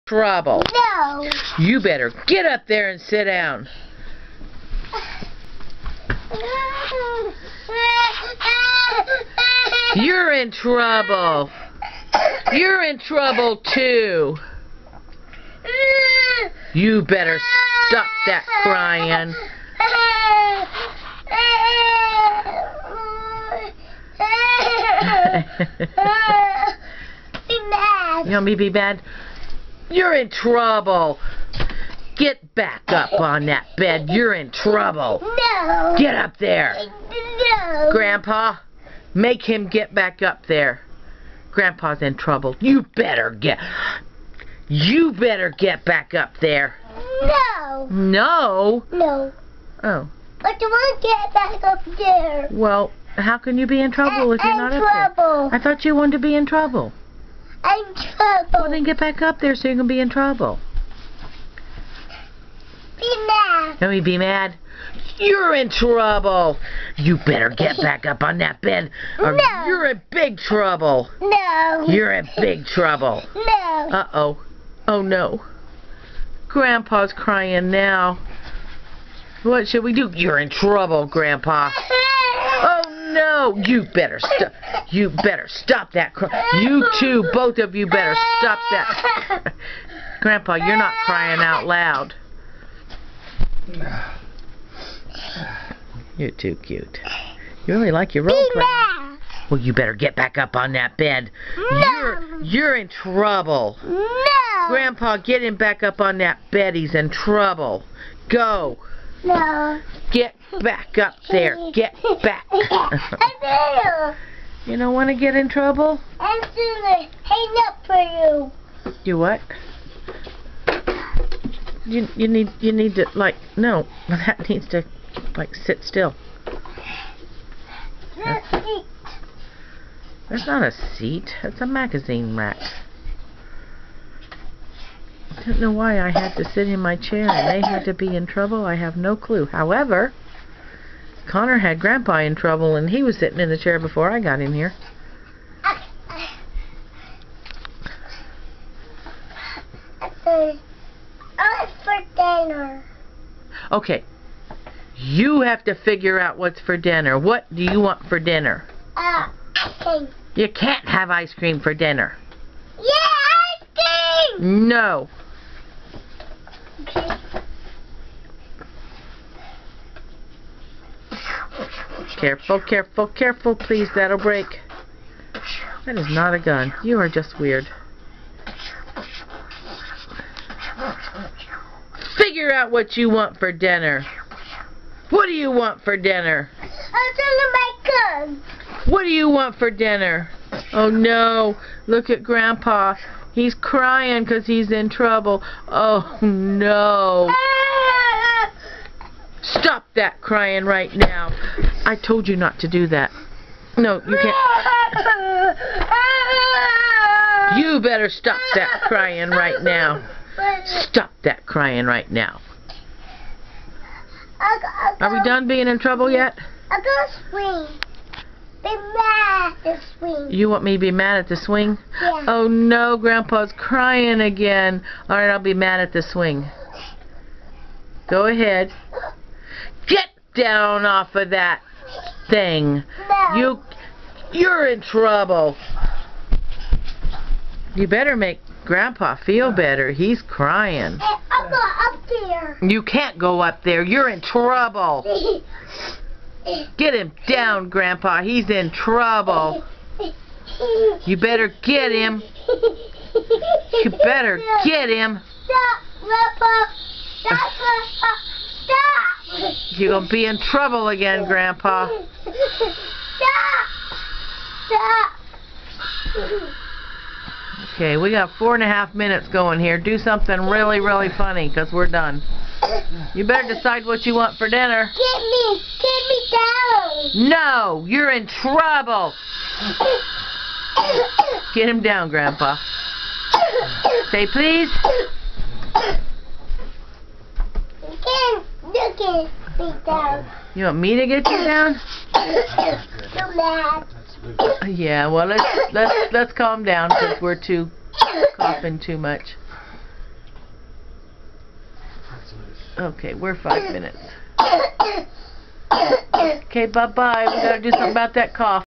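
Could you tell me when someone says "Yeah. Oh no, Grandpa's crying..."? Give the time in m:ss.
3:42.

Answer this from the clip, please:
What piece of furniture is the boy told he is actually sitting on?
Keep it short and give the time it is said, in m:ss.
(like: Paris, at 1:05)
magazine rack, at 2:11.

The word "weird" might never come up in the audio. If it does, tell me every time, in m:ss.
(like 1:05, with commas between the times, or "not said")
2:57.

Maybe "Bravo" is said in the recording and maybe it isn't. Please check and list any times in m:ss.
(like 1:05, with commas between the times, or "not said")
0:00.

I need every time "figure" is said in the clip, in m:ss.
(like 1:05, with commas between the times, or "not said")
2:35, 3:02.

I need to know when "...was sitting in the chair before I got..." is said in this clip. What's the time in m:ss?
2:23.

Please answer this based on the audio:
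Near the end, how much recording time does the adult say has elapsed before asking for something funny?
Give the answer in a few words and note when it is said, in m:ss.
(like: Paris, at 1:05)
4 and a half minutes, at 4:28.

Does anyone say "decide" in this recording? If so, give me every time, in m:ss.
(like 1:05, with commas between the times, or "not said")
4:33.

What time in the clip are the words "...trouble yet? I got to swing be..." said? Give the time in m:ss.
3:35.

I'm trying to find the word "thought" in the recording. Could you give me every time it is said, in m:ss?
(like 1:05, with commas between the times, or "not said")
0:55.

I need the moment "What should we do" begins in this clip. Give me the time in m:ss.
1:19.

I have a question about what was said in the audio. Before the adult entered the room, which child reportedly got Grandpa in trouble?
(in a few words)
Connor.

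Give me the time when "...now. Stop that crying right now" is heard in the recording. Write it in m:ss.
3:29.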